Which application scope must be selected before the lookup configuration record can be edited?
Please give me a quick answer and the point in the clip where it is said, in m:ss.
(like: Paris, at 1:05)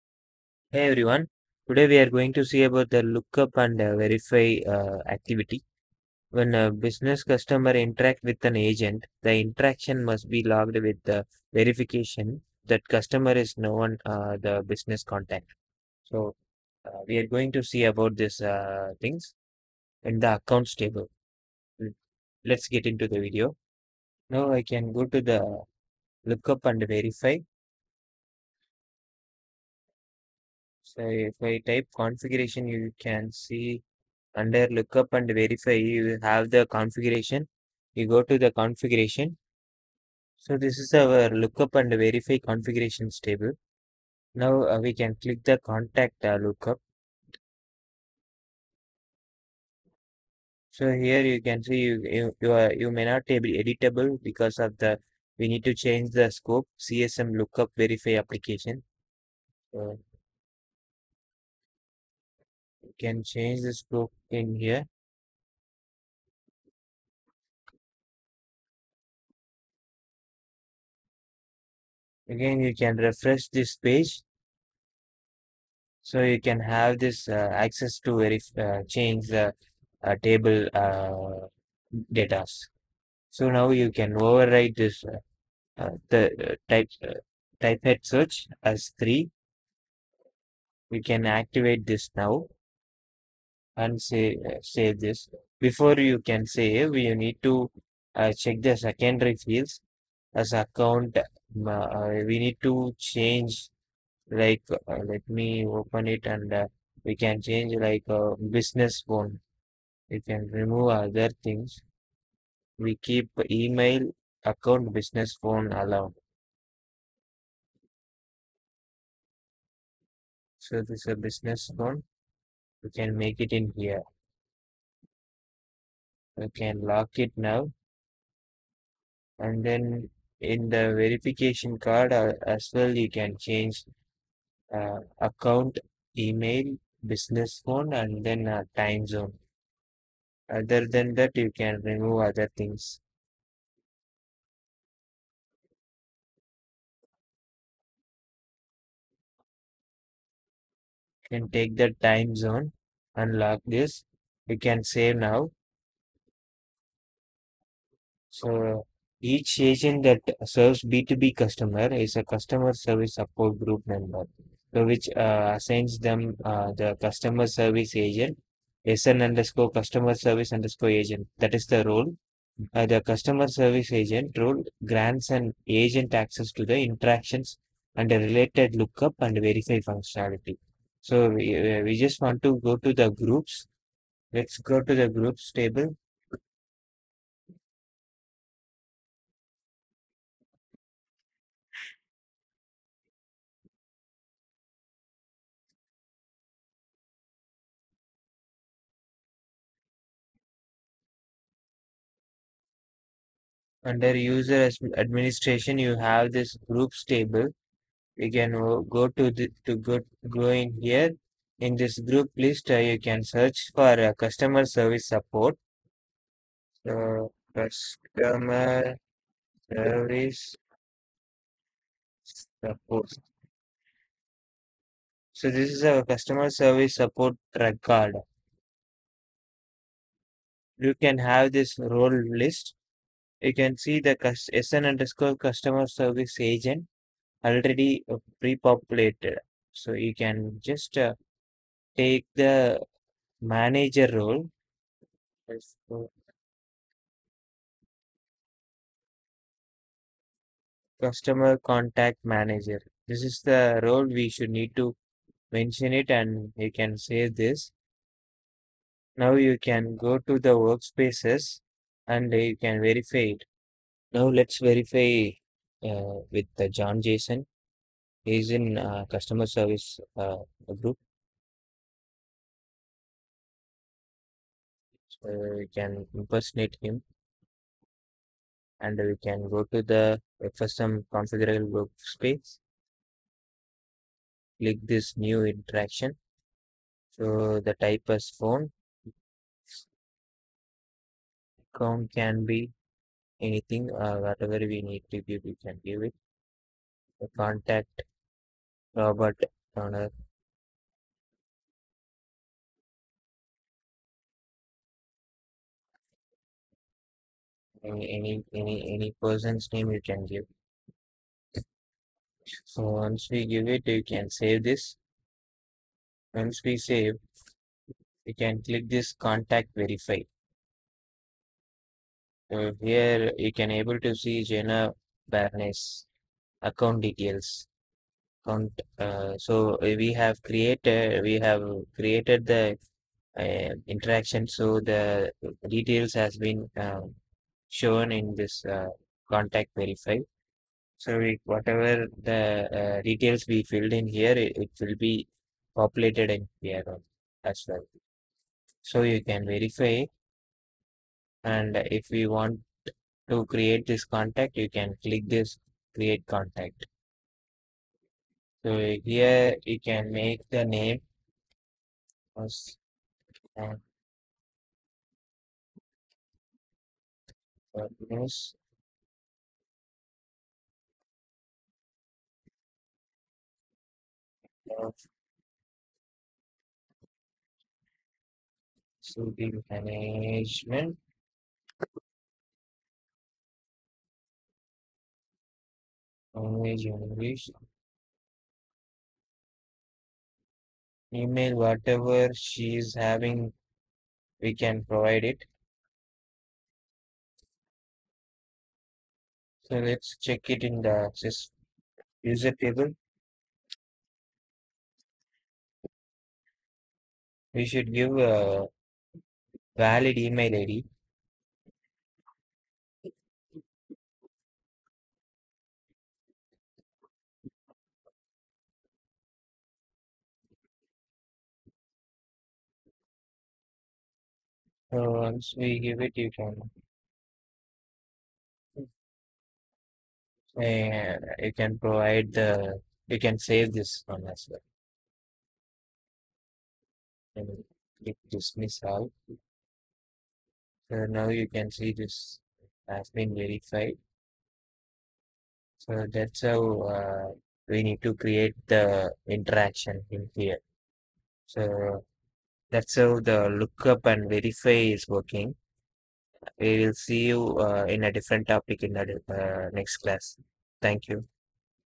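CSM lookup verify, at 0:56.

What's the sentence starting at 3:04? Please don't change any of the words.
Let's go to the groups table.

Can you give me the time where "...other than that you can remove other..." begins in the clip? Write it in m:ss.
2:20.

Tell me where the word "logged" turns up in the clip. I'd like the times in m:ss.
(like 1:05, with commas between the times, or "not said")
0:10.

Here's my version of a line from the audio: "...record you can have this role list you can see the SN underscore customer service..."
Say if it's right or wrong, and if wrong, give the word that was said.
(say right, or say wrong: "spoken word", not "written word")
right.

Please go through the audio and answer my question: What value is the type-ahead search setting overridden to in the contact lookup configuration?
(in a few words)
3.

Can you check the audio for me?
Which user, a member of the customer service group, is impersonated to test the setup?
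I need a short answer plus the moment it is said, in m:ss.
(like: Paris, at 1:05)
John Jason, at 4:26.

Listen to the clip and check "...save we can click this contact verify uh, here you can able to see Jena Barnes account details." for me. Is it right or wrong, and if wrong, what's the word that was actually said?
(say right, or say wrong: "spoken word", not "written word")
right.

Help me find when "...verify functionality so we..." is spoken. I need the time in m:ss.
2:59.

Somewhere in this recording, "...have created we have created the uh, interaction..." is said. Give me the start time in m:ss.
5:30.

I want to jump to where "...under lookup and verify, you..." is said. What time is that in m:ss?
0:34.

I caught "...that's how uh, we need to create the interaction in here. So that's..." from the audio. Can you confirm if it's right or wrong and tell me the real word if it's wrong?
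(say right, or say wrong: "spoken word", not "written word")
right.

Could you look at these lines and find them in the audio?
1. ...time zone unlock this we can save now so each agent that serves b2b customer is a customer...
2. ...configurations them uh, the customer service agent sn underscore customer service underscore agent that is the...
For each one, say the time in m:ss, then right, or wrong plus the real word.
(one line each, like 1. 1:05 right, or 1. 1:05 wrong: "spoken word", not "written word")
1. 2:32 right
2. 2:45 wrong: "assigns", not "configurations".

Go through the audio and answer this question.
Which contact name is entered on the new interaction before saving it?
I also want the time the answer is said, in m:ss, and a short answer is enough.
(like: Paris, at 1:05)
Robert Turner, at 4:58.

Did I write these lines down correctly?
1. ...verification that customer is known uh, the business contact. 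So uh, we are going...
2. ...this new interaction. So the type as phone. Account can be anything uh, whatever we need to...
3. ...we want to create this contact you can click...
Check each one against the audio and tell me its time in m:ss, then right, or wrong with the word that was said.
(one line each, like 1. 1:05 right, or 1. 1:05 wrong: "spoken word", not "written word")
1. 0:11 right
2. 4:44 right
3. 5:52 right.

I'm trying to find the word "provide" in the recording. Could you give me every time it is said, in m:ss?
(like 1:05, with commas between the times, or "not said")
6:34, 7:11.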